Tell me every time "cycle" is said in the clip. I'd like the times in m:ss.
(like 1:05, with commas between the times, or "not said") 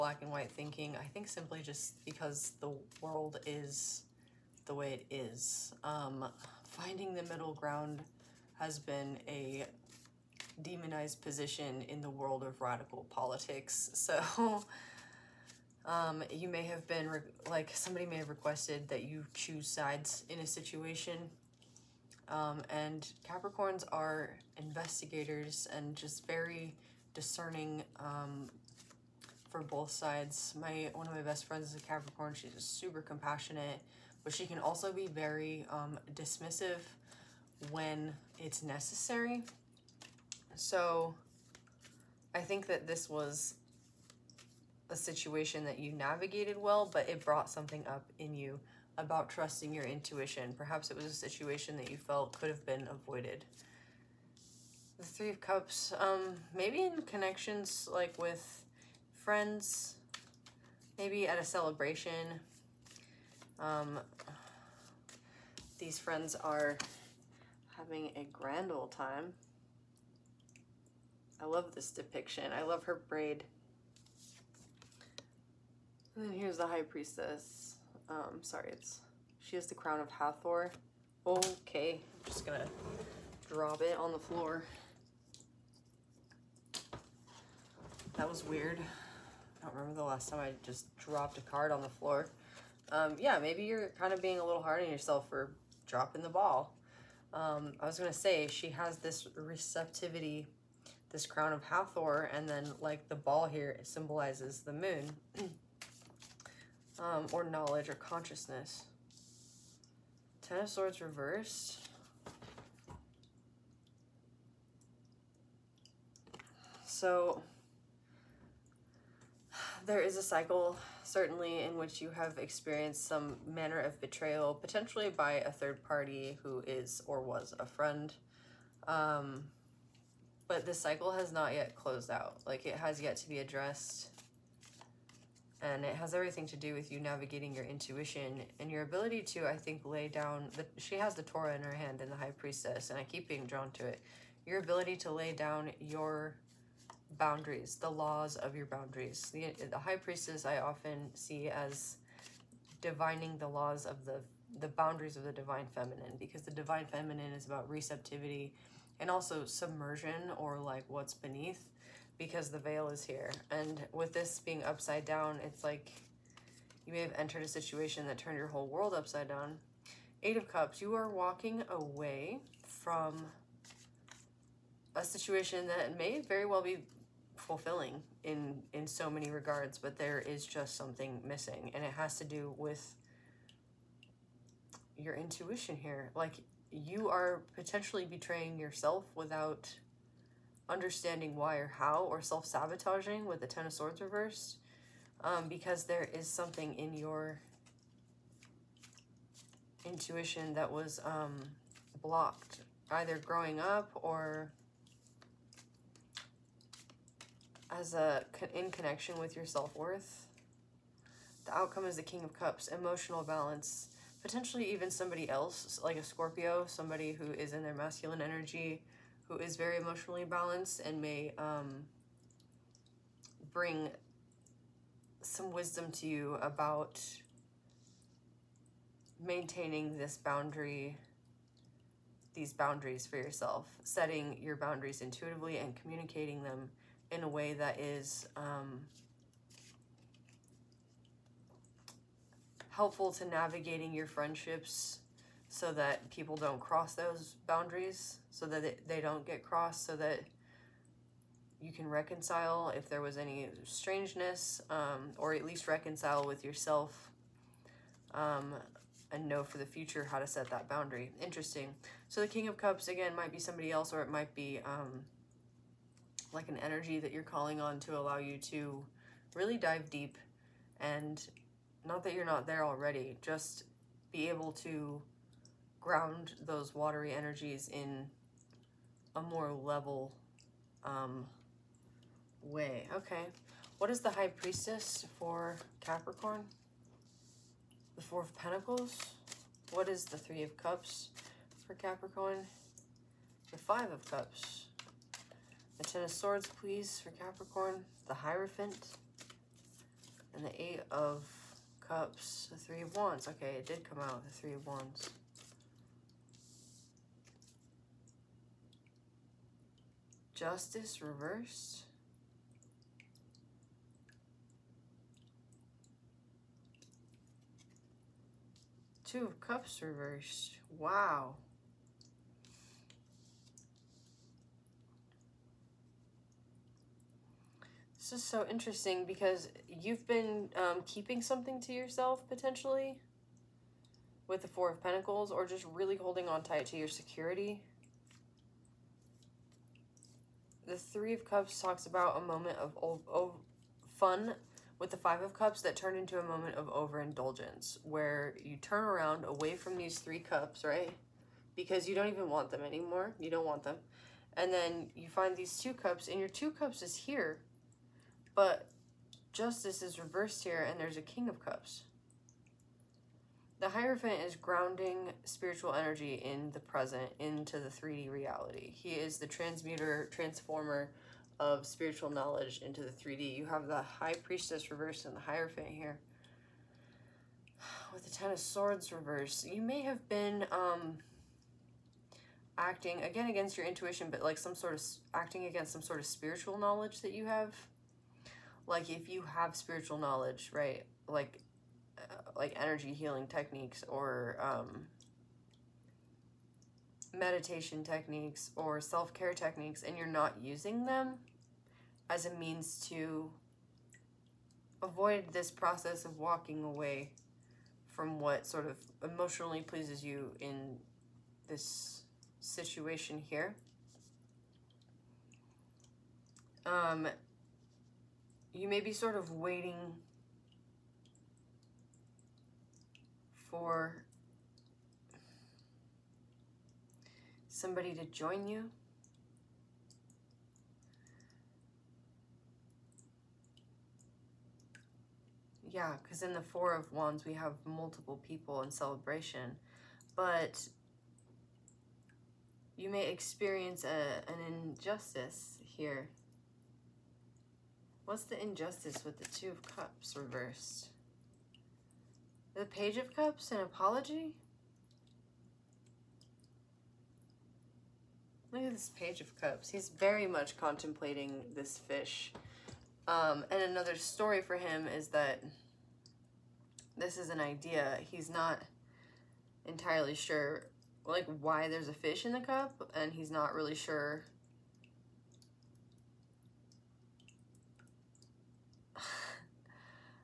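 2:00, 2:10.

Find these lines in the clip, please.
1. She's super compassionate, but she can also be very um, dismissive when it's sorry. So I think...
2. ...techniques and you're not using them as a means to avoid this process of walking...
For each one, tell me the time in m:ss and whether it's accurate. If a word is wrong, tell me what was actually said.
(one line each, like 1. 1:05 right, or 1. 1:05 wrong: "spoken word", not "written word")
1. 0:32 wrong: "necessary", not "sorry"
2. 6:39 right.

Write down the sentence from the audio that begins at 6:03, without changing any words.
The Hierophant is grounding spiritual energy in the present, into the 3D reality.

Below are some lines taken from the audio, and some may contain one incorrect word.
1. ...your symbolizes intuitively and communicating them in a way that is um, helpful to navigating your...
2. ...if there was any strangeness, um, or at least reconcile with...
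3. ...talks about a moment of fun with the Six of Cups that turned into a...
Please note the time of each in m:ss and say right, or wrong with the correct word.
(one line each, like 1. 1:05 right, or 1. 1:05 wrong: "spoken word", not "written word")
1. 3:54 wrong: "boundaries", not "symbolizes"
2. 4:12 right
3. 5:41 wrong: "Five", not "Six".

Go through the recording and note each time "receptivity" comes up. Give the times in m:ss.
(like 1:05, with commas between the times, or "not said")
1:39, 2:37.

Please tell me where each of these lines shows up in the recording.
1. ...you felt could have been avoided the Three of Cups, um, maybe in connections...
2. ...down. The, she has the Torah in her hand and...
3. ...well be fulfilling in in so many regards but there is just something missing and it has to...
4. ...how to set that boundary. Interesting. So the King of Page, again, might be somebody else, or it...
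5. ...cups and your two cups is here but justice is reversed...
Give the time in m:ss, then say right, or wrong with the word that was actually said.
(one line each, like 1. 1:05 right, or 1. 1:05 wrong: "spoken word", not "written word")
1. 0:51 right
2. 2:20 right
3. 2:56 right
4. 4:20 wrong: "Cups", not "Page"
5. 5:55 right.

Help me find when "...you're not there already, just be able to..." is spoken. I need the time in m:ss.
4:32.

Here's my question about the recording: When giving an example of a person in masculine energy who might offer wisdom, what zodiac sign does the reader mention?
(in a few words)
Scorpio.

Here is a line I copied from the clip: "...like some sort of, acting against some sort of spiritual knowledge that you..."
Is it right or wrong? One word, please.
right.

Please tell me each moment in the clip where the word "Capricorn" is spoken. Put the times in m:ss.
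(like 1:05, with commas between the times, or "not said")
0:23, 0:31, 4:45, 4:51, 4:57.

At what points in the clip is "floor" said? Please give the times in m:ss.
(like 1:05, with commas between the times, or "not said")
1:24, 1:31.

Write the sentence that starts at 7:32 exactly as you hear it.
The Page of Cups, an apology?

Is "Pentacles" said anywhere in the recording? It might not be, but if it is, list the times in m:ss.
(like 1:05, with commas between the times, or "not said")
4:48, 5:34.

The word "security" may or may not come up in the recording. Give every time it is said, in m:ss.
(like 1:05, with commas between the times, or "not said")
5:36.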